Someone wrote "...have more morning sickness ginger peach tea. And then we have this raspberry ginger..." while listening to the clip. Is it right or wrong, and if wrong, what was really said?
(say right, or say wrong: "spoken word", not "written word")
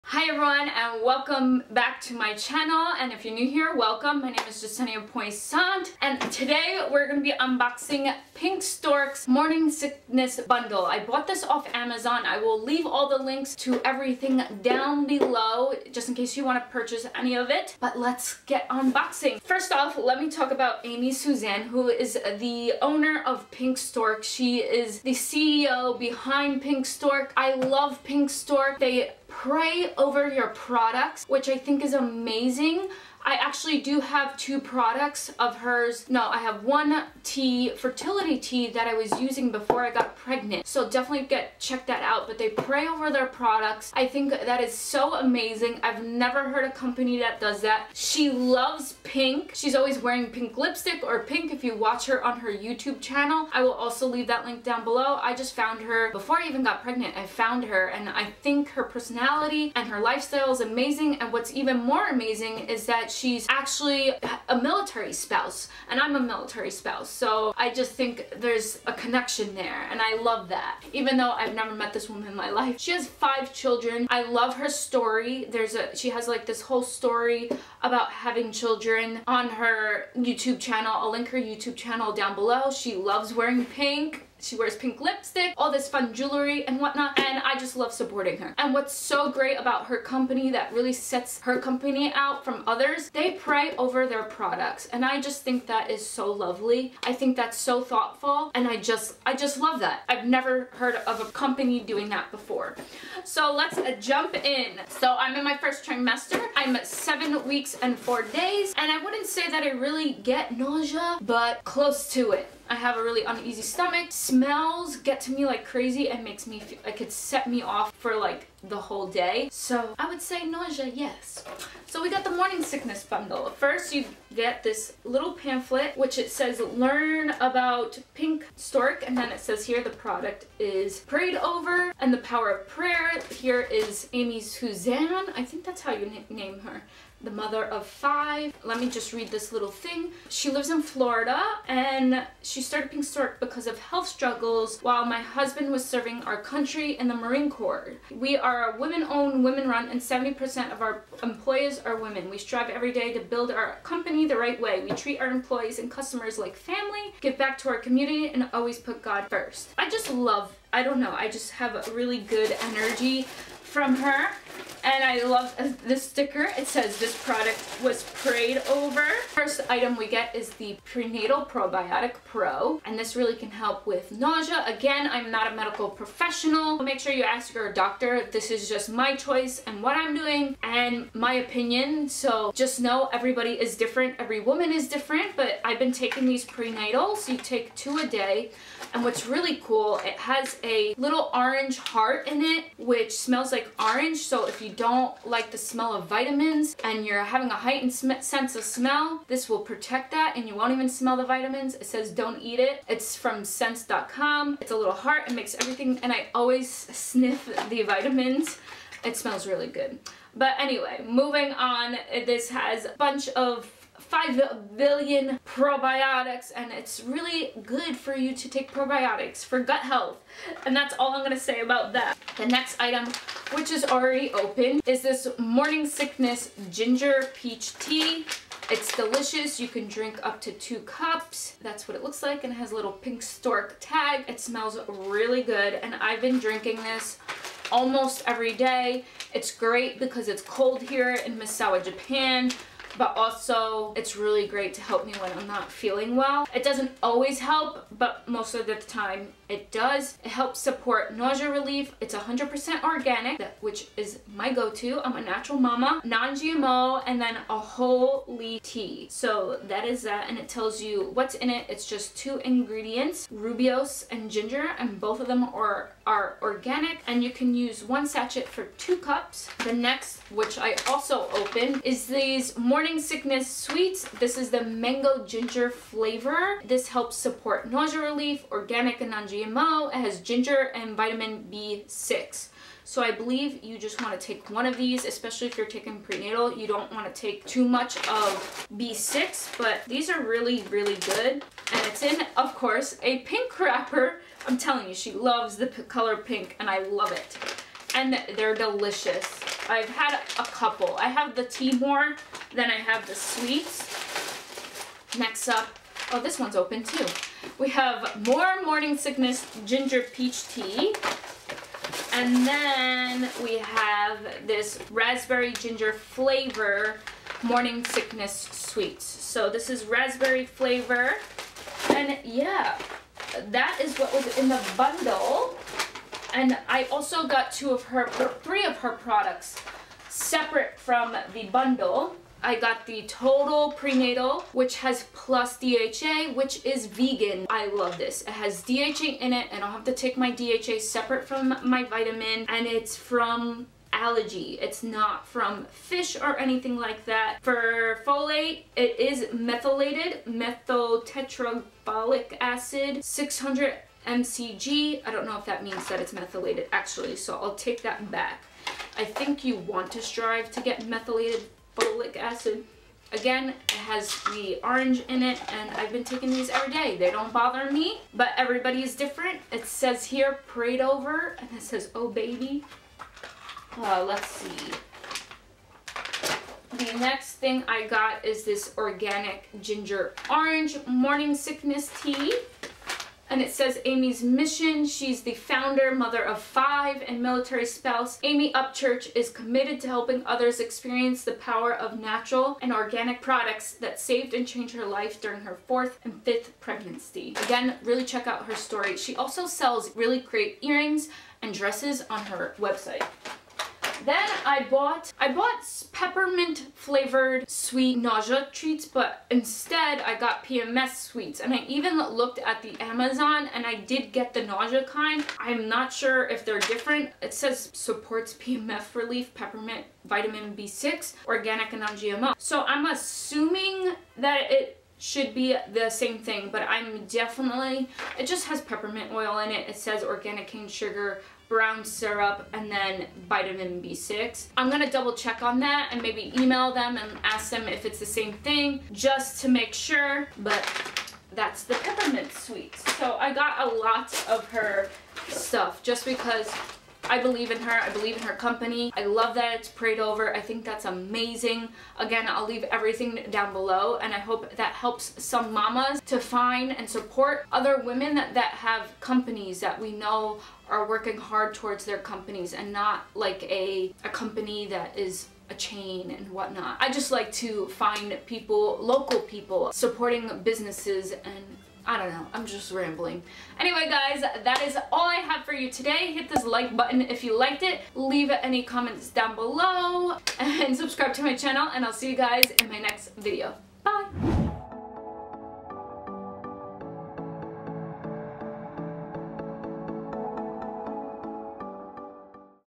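right.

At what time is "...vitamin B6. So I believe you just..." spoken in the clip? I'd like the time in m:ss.
4:40.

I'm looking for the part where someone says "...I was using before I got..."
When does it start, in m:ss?
0:38.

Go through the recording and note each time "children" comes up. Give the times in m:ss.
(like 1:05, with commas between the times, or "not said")
1:13, 1:18.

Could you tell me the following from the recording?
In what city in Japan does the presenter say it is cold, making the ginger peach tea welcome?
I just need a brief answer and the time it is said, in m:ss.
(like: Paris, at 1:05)
Misawa, at 4:01.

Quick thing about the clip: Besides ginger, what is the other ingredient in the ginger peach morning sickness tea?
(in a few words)
Rooibos.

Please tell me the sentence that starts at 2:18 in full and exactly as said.
Let me just read this little thing.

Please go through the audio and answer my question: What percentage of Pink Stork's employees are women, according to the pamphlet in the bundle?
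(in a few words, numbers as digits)
70%.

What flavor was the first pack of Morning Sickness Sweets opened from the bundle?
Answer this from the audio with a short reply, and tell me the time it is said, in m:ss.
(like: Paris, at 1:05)
Mango ginger, at 4:34.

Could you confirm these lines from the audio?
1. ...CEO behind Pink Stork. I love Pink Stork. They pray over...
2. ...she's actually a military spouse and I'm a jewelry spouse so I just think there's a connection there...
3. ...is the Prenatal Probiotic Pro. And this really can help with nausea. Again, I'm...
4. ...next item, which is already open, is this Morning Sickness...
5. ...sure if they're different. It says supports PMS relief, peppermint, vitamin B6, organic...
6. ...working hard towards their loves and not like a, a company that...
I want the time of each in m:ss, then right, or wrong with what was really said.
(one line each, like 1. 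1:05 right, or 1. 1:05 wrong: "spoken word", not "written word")
1. 0:25 right
2. 1:03 wrong: "military", not "jewelry"
3. 2:50 right
4. 3:42 right
5. 6:55 right
6. 7:40 wrong: "companies", not "loves".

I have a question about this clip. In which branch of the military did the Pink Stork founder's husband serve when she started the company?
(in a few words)
Marine Corps.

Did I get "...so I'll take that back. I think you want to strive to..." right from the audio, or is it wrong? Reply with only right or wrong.
right.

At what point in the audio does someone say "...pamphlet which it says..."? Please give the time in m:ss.
2:05.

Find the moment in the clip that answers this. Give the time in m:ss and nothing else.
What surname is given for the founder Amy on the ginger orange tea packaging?
6:28.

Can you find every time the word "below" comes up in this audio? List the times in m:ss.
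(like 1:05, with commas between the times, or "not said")
0:15, 0:54, 1:22, 7:33, 7:59.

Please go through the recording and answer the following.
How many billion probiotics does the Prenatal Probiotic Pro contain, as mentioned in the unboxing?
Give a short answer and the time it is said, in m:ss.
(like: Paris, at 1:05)
5 billion, at 3:34.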